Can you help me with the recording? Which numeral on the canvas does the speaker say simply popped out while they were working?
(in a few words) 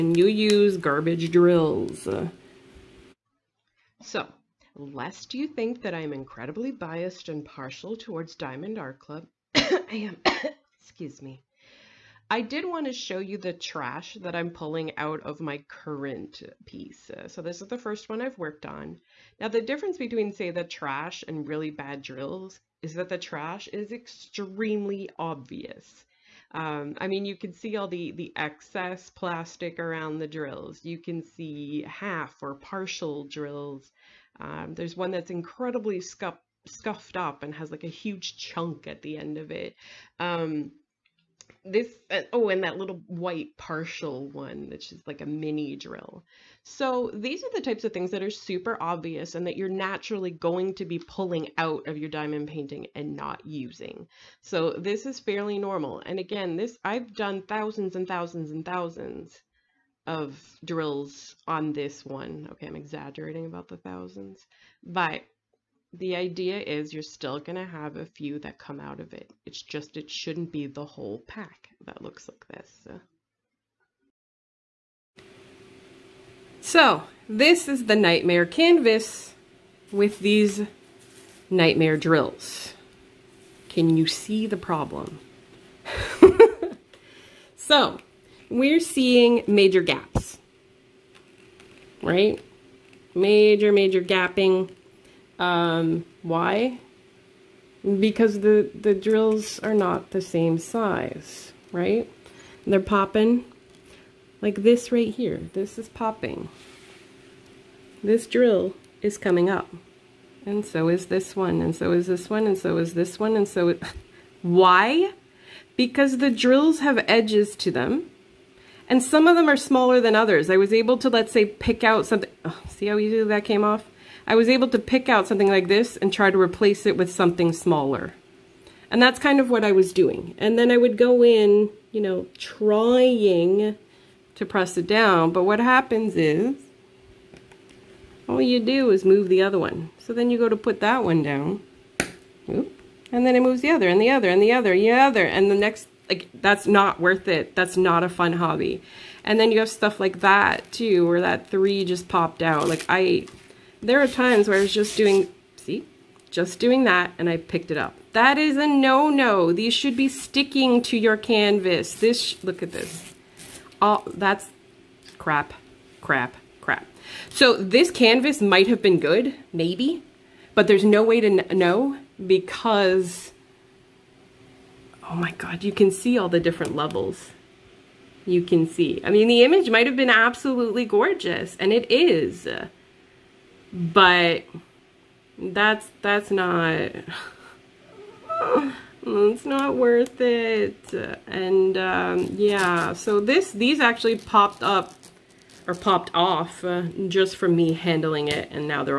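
3.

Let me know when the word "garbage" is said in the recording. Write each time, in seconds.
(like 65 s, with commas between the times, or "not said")
0 s.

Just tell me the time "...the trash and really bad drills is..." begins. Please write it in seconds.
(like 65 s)
20 s.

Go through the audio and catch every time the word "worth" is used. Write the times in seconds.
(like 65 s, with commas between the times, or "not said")
146 s, 189 s.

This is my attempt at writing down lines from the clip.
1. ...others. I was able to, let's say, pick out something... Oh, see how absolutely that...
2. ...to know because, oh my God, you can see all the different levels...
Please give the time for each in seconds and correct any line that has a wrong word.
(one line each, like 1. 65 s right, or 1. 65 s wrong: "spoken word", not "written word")
1. 120 s wrong: "easily", not "absolutely"
2. 171 s right.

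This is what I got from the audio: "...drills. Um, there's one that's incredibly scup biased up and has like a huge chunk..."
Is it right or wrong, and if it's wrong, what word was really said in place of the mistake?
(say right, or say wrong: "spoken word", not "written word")
wrong: "scuffed", not "biased".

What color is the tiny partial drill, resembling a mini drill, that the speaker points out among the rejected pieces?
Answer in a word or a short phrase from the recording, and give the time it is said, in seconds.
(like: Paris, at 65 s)
White, at 43 s.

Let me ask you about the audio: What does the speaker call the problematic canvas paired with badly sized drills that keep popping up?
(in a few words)
nightmare canvas.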